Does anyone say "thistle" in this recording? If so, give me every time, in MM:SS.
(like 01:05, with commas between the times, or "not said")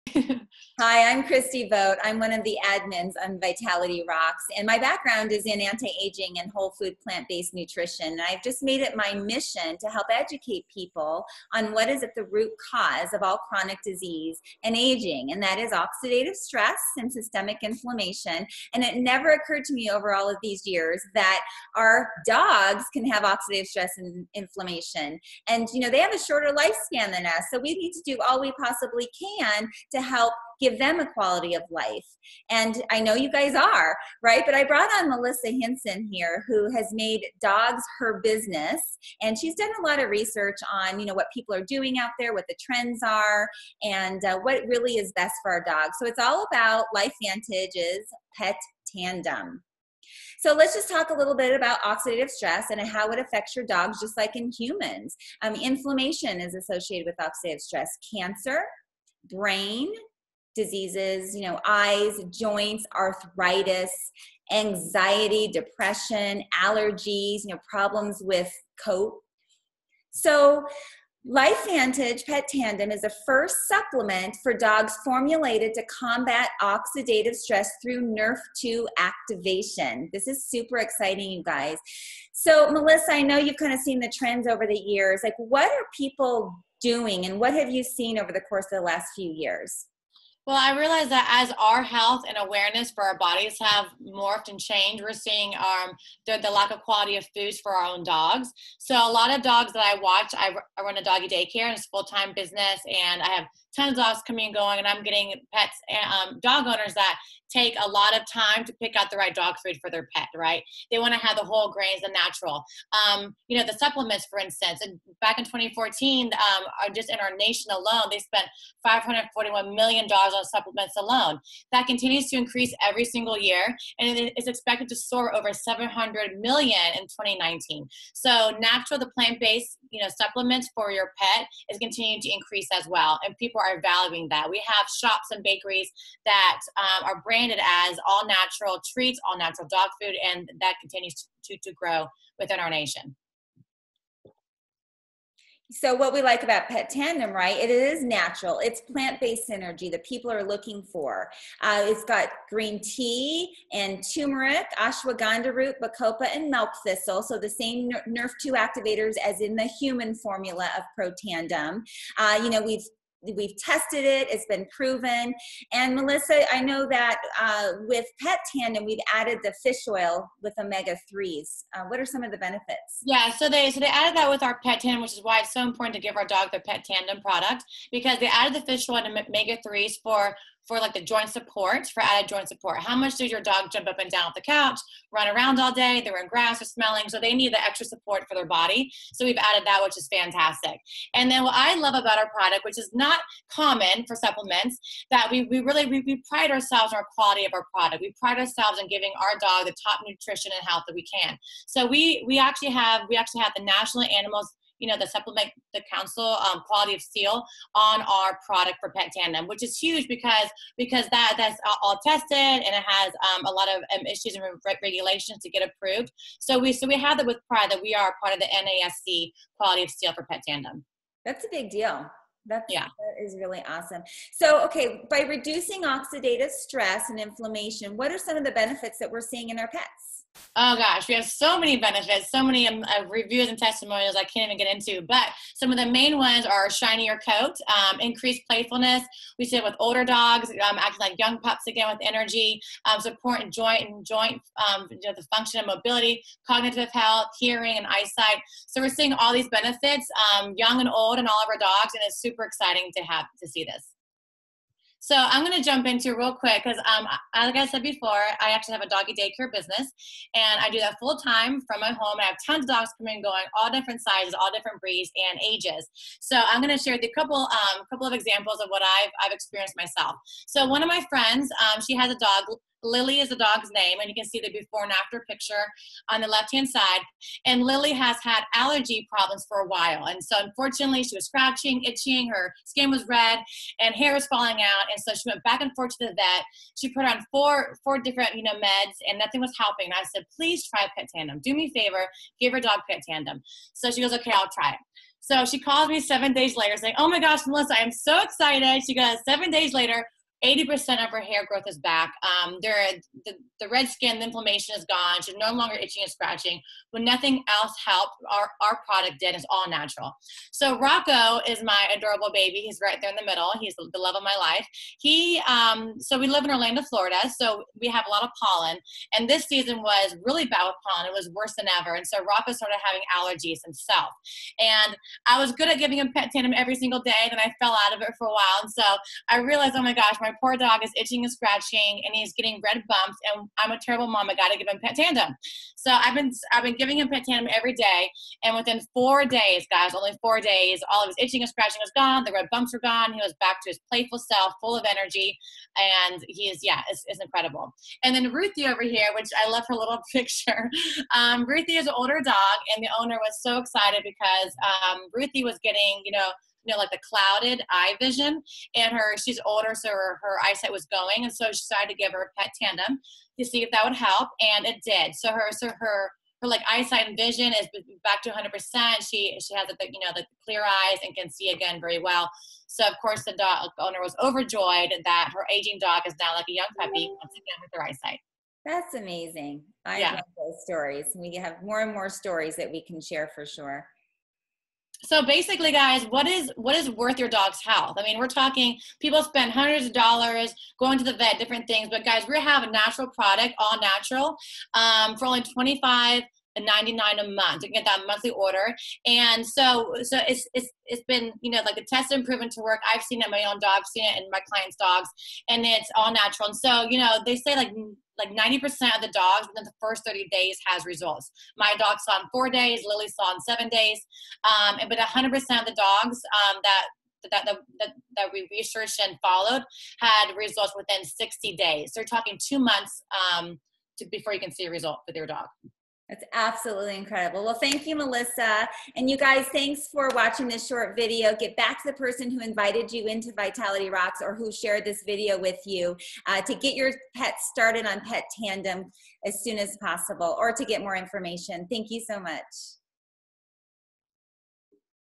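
02:36.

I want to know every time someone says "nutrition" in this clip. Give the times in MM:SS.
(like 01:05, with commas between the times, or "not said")
00:07, 03:20.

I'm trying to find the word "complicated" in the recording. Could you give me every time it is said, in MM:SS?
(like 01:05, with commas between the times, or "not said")
not said.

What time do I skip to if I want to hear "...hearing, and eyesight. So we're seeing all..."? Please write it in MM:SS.
04:07.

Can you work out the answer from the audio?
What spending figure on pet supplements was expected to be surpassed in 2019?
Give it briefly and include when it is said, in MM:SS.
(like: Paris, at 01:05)
700 million, at 02:05.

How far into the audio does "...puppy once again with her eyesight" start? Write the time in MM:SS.
06:16.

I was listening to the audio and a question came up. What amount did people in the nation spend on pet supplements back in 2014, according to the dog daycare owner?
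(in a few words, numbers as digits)
$541 million.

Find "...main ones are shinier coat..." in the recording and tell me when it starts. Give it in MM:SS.
03:55.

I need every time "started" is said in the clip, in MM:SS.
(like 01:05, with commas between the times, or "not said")
05:22, 07:17.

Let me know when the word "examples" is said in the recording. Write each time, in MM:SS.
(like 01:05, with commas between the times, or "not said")
04:28.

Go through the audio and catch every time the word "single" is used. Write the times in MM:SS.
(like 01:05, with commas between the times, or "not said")
02:03, 05:26.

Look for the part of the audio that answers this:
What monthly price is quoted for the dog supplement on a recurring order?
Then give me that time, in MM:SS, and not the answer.
06:35.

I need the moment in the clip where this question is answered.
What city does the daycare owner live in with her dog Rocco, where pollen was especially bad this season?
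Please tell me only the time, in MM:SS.
05:16.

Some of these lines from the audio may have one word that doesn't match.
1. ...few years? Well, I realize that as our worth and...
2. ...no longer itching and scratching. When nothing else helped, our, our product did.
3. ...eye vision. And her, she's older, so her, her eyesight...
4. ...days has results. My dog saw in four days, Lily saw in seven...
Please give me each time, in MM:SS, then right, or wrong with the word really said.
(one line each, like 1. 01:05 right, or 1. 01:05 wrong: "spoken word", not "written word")
1. 01:29 wrong: "health", not "worth"
2. 05:05 right
3. 05:57 right
4. 06:50 right.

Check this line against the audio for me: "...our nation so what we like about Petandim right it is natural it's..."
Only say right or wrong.
right.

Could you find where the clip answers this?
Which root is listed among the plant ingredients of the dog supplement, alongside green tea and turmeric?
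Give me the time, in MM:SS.
02:34.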